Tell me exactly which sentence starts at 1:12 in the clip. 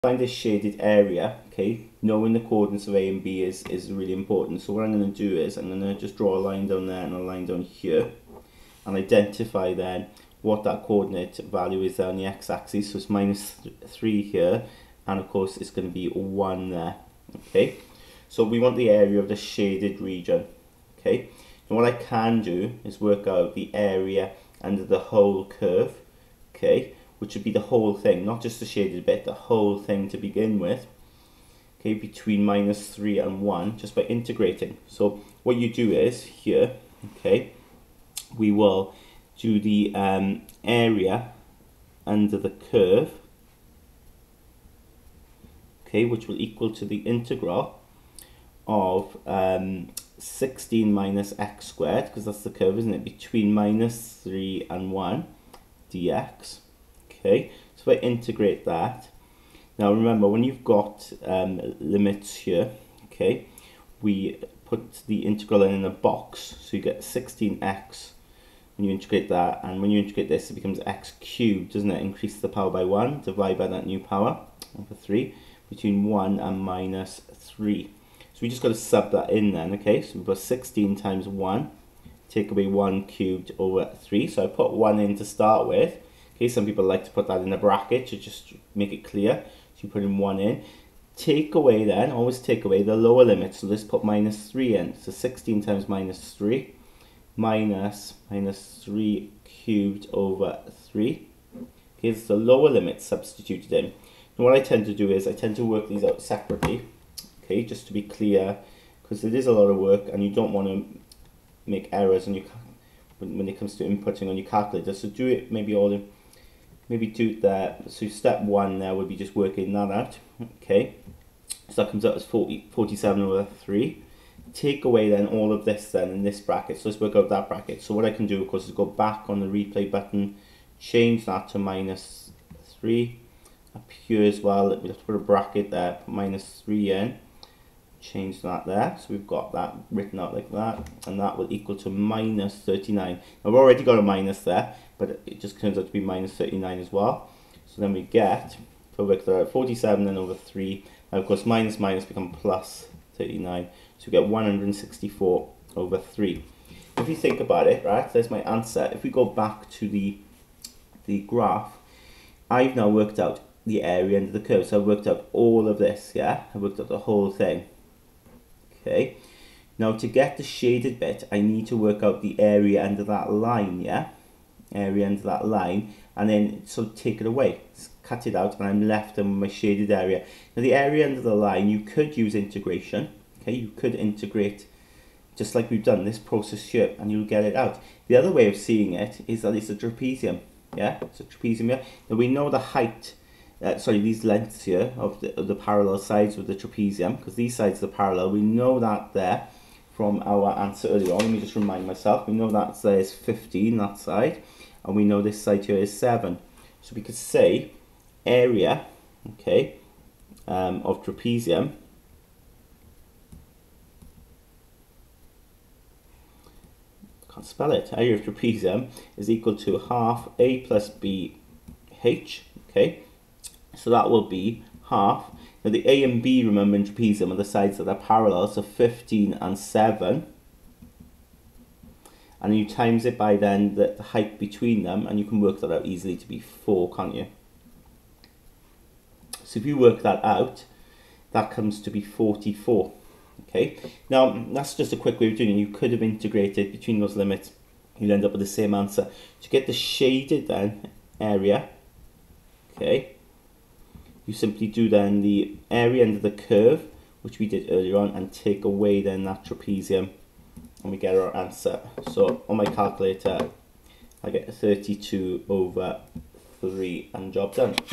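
Increase the power by 1, divide by that new power over 3, between 1 and minus 3.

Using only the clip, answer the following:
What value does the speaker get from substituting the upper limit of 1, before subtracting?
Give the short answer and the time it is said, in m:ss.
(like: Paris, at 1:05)
47/3, at 2:02.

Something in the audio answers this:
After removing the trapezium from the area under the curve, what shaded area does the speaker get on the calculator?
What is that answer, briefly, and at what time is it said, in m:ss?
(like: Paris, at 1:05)
32/3, at 4:24.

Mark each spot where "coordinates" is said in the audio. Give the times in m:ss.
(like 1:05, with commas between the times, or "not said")
0:02, 0:10.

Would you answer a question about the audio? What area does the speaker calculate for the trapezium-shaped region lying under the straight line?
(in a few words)
44.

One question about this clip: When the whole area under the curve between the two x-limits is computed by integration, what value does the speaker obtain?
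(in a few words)
164/3.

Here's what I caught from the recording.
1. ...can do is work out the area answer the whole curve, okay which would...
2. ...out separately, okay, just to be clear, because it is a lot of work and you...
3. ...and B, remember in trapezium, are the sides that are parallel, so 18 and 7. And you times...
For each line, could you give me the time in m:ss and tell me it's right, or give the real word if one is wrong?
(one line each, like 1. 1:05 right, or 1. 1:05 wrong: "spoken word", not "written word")
1. 0:21 wrong: "under", not "answer"
2. 1:46 right
3. 3:46 wrong: "15", not "18".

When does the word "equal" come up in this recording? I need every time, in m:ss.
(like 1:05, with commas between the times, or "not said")
0:46, 2:21, 3:39.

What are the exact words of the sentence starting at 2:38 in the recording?
If we go back to the, the graph, I've now worked out the area under the curve.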